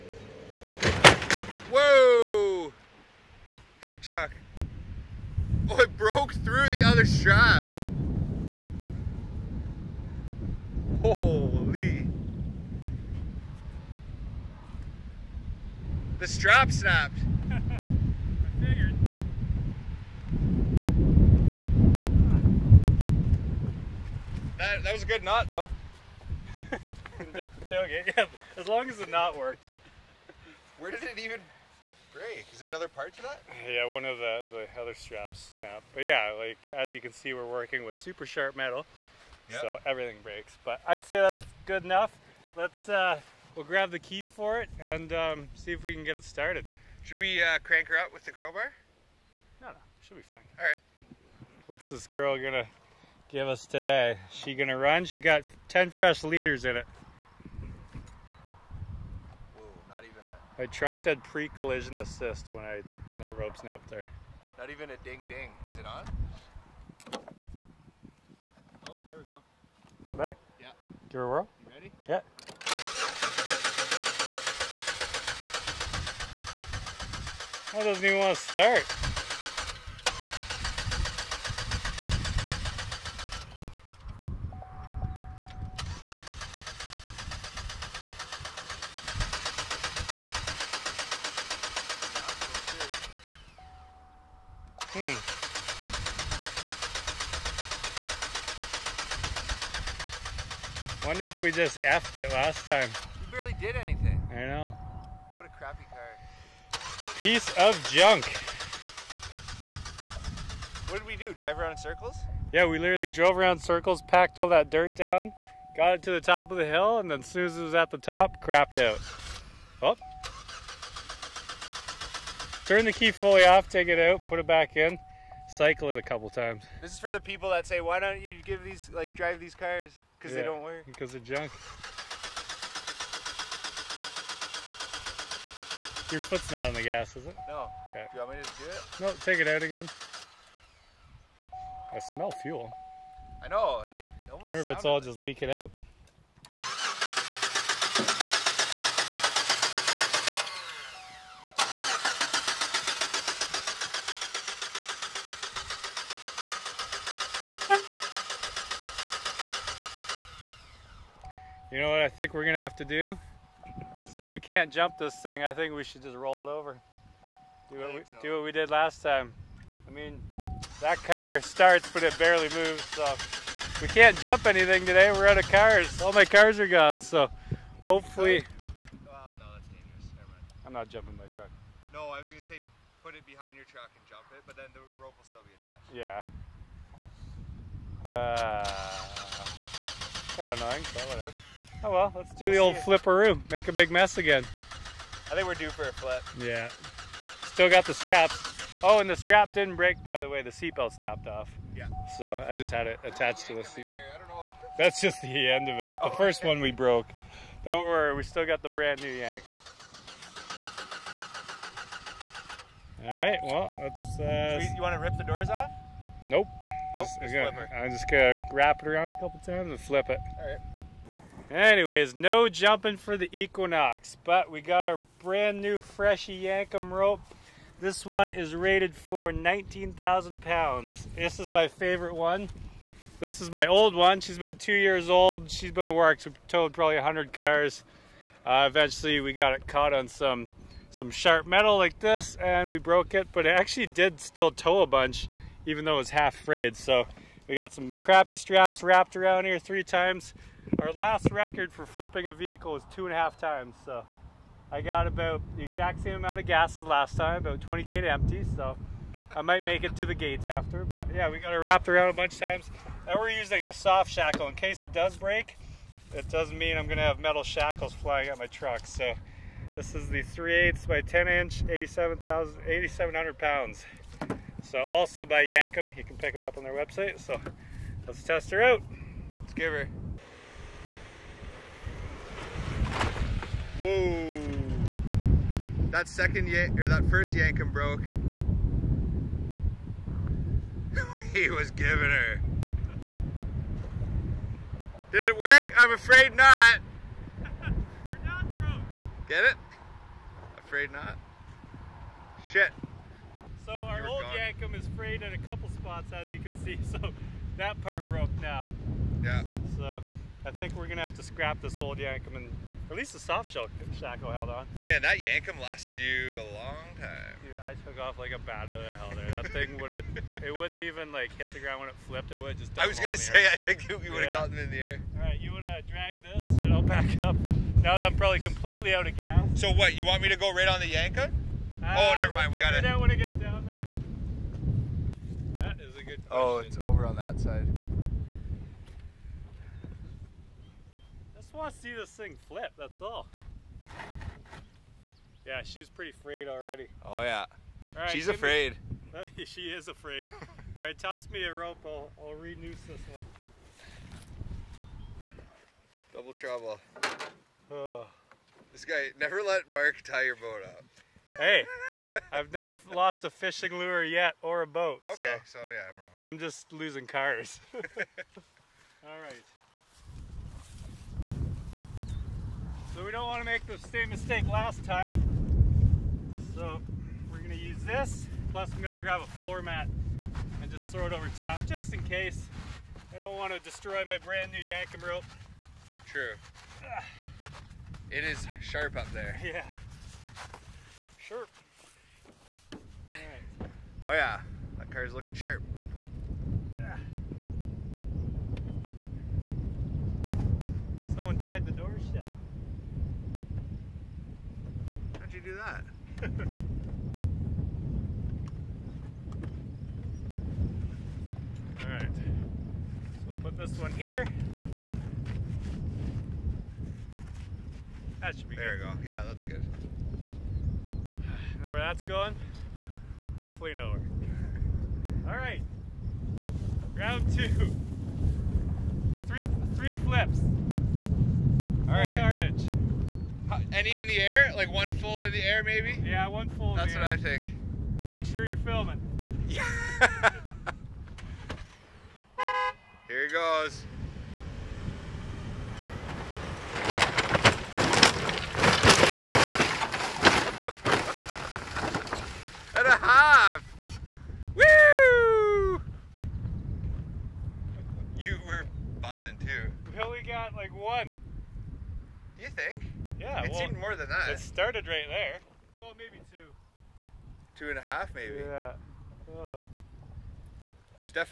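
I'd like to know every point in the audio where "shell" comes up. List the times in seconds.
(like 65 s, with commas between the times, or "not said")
313 s.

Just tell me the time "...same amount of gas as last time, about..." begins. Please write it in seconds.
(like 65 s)
256 s.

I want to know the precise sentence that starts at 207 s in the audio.
Don't worry, we still got the brand new Yankum.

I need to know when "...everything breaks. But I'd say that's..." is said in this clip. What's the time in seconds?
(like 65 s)
39 s.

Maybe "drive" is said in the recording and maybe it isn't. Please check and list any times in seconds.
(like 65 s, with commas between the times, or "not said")
111 s, 129 s.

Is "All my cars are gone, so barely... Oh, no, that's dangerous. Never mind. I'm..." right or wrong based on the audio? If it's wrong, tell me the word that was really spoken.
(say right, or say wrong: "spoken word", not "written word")
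wrong: "hopefully", not "barely".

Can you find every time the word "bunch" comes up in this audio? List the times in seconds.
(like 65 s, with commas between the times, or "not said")
244 s, 262 s.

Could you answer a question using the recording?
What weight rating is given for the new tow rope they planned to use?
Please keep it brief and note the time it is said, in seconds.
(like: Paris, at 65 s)
19,000 pounds, at 229 s.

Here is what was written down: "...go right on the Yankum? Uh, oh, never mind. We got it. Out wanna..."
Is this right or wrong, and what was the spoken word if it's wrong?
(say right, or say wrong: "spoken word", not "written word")
right.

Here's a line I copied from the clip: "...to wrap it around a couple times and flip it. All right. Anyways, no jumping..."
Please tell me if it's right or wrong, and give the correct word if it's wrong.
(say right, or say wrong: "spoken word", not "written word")
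right.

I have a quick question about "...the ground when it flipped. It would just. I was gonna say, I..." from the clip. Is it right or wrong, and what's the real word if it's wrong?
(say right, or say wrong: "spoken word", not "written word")
right.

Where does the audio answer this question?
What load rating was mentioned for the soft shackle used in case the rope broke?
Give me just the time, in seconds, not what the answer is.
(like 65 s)
271 s.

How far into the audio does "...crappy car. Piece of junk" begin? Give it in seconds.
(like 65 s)
105 s.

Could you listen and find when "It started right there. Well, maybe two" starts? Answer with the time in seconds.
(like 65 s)
464 s.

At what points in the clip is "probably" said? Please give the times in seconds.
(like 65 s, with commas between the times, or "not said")
236 s, 328 s.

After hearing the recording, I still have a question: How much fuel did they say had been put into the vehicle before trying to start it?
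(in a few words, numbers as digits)
10 liters.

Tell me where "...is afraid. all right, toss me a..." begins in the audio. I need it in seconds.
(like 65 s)
349 s.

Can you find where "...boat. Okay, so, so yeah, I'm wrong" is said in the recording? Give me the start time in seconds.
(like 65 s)
364 s.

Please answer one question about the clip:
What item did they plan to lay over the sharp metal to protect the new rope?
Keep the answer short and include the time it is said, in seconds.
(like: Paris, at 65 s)
a floor mat, at 379 s.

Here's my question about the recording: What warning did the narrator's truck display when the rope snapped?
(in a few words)
pre-collision assist.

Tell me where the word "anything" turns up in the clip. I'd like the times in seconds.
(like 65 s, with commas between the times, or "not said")
103 s, 174 s.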